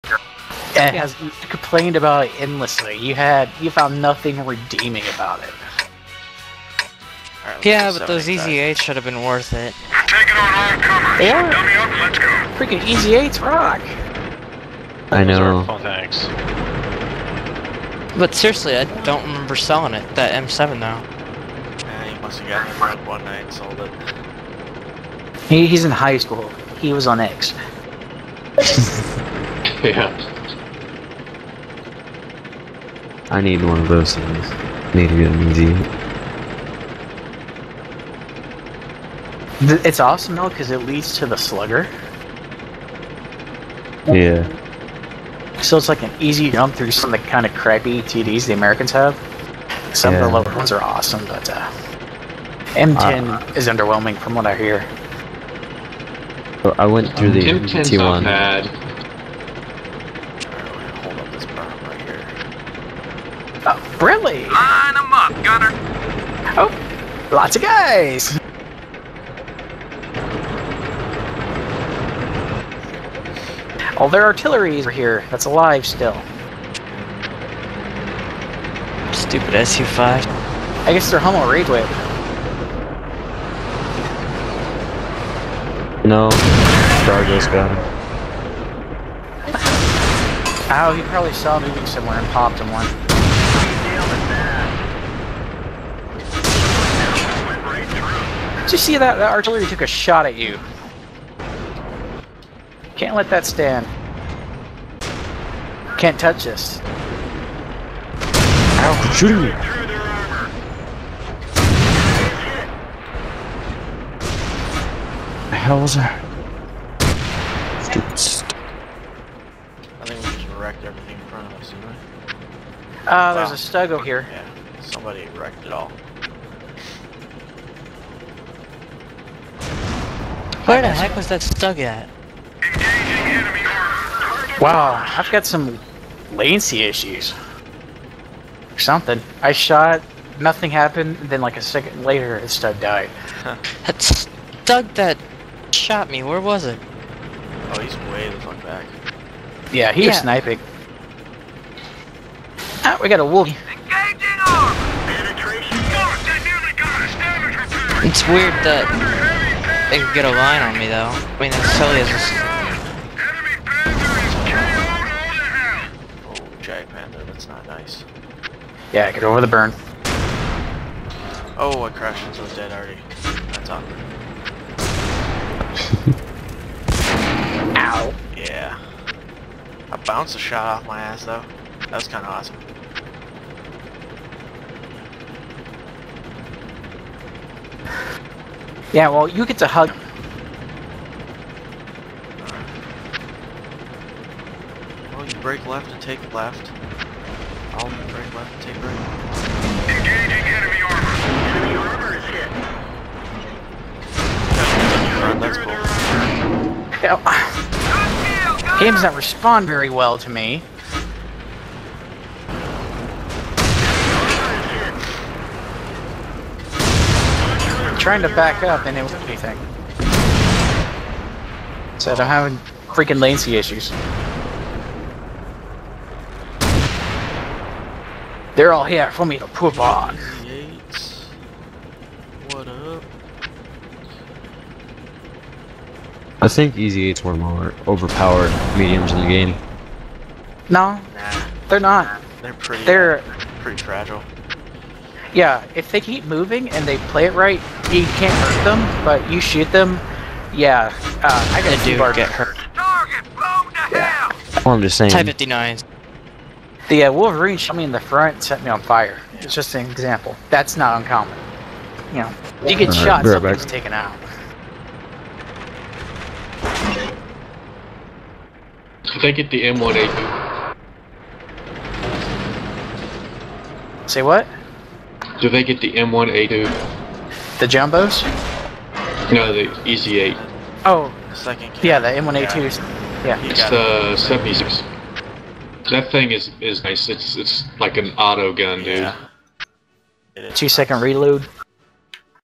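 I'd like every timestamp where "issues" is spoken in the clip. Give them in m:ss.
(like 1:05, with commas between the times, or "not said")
2:16, 3:43.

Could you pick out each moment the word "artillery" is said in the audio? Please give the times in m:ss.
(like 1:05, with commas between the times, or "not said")
1:14, 1:39.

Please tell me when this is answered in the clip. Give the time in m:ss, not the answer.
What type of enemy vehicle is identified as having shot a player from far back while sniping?
2:27.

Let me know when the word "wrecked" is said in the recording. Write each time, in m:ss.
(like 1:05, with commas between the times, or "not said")
2:00, 2:05.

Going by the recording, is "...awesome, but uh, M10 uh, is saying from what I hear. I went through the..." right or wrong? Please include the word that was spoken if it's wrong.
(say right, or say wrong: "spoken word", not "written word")
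wrong: "underwhelming", not "saying".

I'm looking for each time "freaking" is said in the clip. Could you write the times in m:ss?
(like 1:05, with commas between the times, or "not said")
0:12, 3:42.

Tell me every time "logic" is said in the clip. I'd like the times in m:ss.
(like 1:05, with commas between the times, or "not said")
not said.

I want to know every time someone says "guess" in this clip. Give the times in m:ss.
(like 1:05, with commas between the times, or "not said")
1:20.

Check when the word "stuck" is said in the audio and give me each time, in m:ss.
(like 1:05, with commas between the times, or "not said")
2:11.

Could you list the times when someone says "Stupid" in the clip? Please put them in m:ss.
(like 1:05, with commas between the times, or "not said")
1:19, 1:57.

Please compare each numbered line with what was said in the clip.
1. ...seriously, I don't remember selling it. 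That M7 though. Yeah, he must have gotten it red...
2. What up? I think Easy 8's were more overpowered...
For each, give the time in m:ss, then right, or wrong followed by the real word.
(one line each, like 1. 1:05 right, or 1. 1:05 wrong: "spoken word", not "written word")
1. 0:18 right
2. 3:52 right.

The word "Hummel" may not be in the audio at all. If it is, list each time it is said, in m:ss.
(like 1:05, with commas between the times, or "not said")
1:21.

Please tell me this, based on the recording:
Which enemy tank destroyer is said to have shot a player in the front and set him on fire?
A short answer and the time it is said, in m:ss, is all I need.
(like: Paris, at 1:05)
Wolverine, at 4:17.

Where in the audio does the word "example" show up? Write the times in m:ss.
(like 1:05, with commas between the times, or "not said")
4:19.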